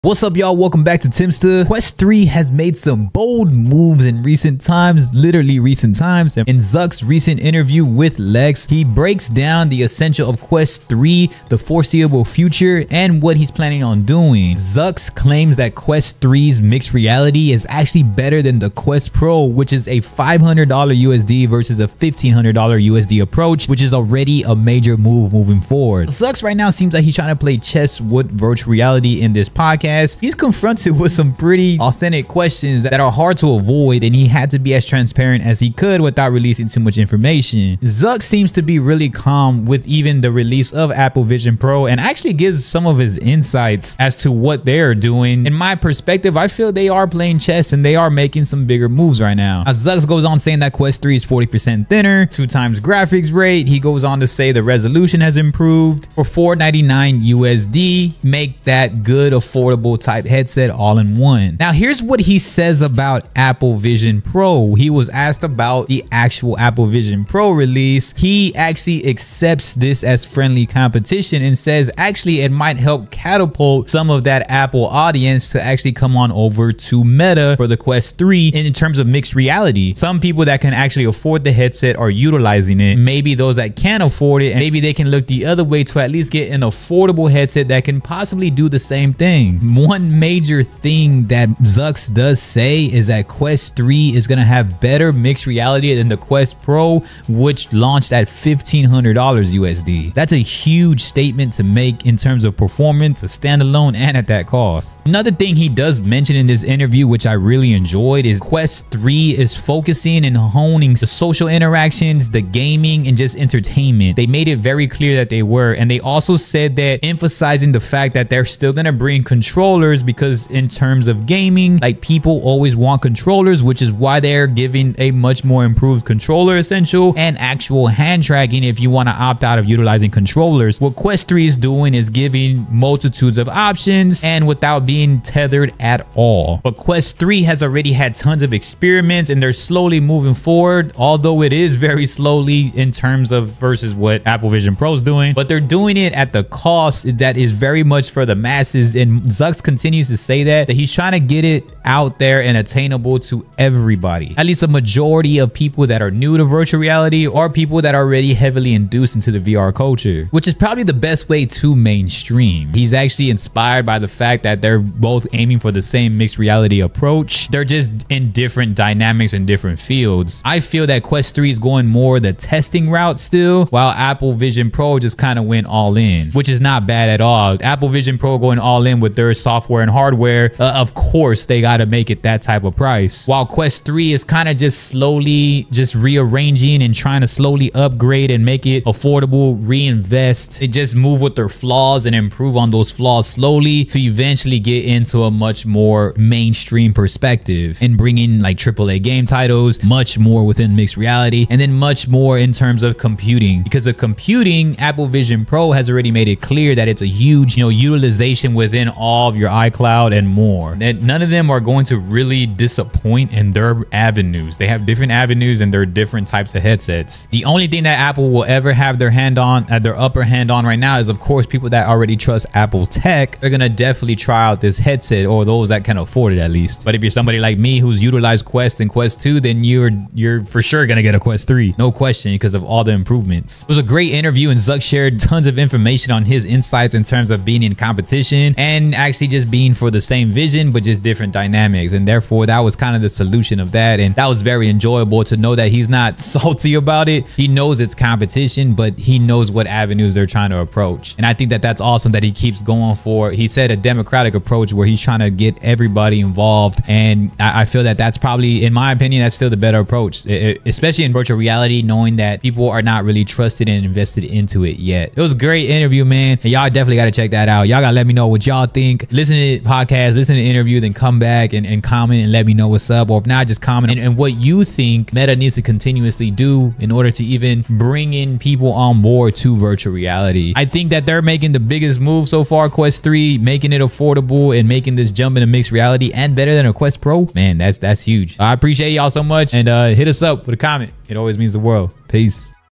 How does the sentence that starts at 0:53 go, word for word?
He goes on to say the resolution has improved for 499 USD.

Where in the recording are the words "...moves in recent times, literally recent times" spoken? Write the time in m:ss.
0:03.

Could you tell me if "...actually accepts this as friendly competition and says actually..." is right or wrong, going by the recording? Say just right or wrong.
right.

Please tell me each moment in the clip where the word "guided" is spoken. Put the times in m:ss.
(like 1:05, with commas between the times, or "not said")
not said.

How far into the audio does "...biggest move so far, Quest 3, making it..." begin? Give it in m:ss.
4:41.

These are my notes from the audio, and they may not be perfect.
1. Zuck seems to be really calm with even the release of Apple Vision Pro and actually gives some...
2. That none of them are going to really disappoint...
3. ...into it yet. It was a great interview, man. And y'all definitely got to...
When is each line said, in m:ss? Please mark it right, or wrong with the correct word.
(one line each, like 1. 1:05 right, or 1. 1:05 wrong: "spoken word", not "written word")
1. 0:37 right
2. 3:30 right
3. 4:24 right.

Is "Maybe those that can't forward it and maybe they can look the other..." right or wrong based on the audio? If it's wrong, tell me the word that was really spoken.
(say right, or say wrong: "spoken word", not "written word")
wrong: "afford", not "forward".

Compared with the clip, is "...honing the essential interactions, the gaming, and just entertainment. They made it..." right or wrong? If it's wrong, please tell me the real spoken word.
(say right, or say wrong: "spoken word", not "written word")
wrong: "social", not "essential".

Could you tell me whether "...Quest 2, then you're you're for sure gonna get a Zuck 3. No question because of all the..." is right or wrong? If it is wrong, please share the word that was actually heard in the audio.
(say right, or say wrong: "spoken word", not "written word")
wrong: "Quest", not "Zuck".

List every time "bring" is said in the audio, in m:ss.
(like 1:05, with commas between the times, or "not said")
1:58, 3:17, 4:37.